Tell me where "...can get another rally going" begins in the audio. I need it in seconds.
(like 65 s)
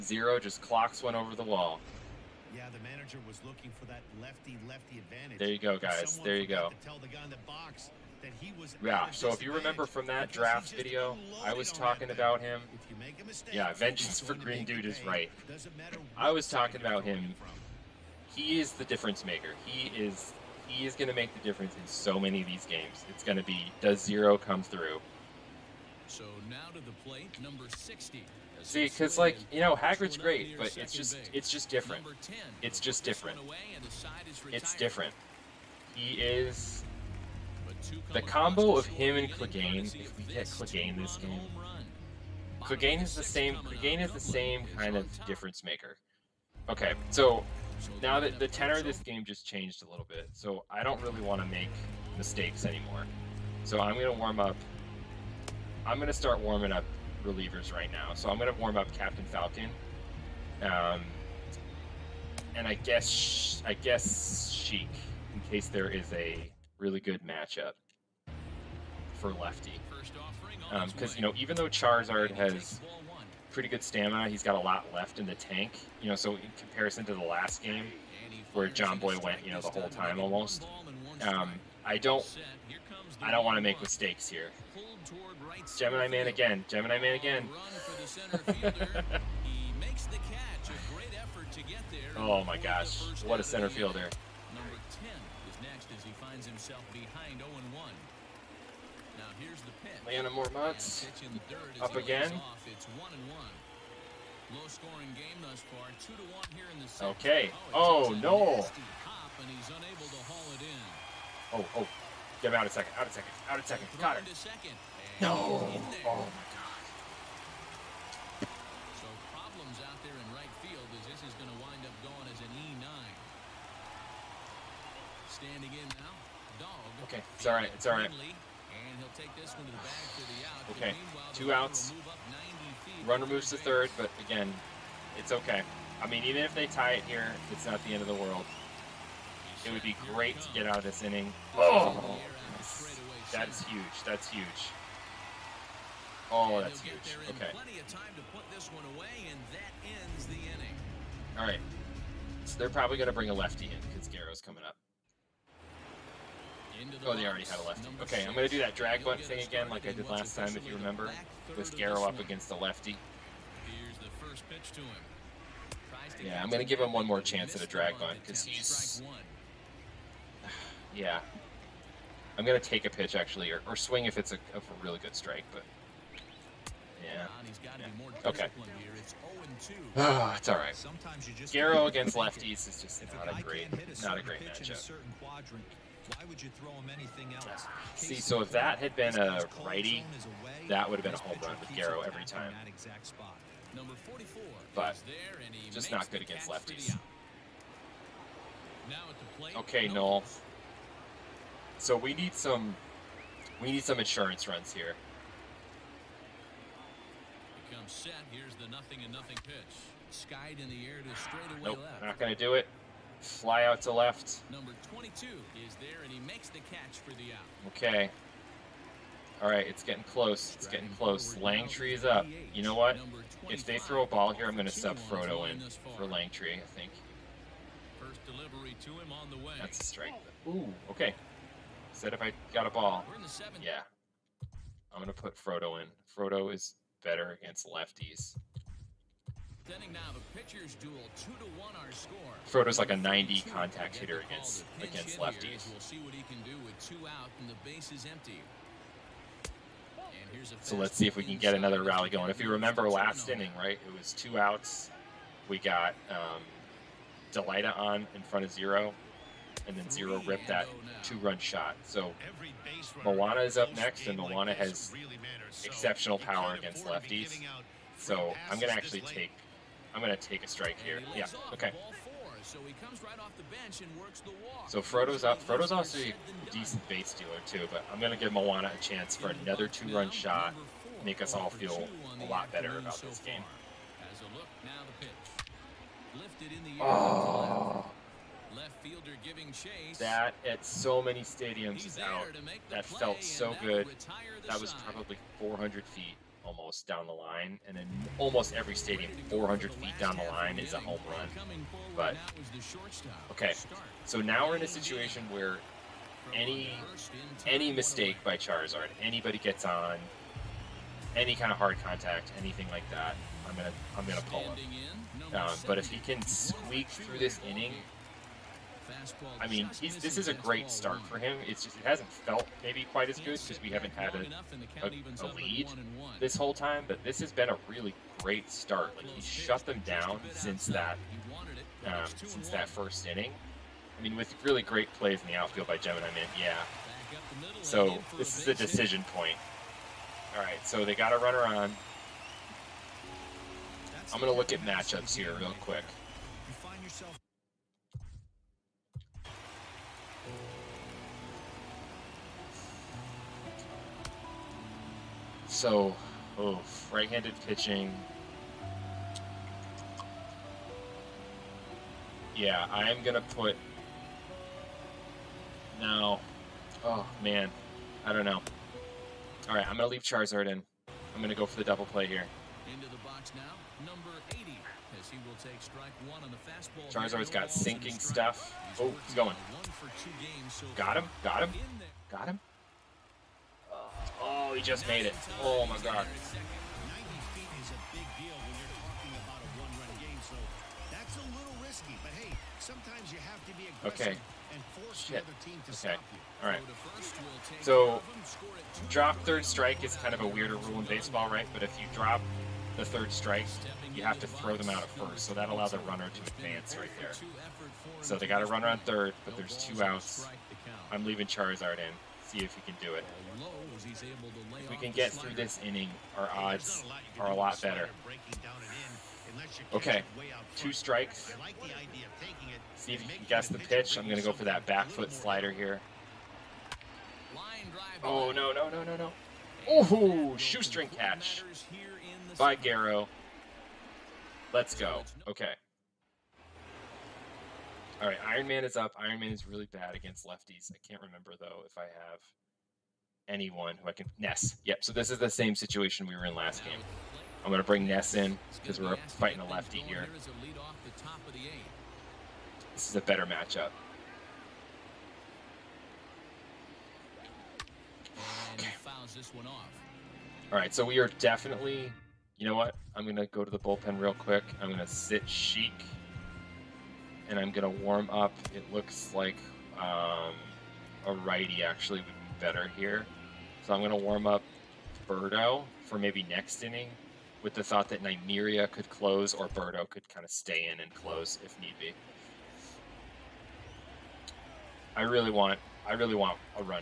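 251 s.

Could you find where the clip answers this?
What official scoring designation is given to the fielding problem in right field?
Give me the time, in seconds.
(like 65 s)
122 s.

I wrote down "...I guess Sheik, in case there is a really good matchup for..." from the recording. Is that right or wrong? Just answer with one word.
right.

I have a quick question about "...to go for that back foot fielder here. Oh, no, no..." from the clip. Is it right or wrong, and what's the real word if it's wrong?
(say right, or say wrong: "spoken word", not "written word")
wrong: "slider", not "fielder".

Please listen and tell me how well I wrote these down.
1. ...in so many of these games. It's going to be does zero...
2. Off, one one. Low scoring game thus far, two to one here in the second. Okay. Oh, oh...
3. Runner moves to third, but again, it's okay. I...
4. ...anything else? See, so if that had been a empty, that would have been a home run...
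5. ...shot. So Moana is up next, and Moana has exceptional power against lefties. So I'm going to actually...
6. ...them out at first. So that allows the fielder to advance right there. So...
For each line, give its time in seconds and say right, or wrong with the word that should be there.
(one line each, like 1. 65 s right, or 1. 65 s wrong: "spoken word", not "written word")
1. 21 s right
2. 102 s right
3. 133 s right
4. 186 s wrong: "righty", not "empty"
5. 261 s right
6. 404 s wrong: "runner", not "fielder".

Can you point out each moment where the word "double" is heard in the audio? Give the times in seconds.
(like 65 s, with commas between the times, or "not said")
371 s.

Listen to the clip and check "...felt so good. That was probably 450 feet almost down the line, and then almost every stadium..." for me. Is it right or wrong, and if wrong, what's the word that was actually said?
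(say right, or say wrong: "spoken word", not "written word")
wrong: "400", not "450".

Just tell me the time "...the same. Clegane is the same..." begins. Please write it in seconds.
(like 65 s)
43 s.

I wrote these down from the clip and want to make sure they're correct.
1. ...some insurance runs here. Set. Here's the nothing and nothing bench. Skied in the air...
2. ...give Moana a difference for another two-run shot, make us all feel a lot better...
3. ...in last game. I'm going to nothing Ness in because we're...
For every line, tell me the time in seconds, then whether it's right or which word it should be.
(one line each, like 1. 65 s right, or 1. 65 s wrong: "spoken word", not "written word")
1. 203 s wrong: "pitch", not "bench"
2. 278 s wrong: "chance", not "difference"
3. 446 s wrong: "bring", not "nothing".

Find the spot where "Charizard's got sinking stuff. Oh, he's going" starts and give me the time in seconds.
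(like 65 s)
376 s.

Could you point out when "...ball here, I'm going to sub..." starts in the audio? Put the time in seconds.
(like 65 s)
224 s.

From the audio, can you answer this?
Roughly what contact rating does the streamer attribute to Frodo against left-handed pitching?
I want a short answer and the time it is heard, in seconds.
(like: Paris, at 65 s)
90, at 242 s.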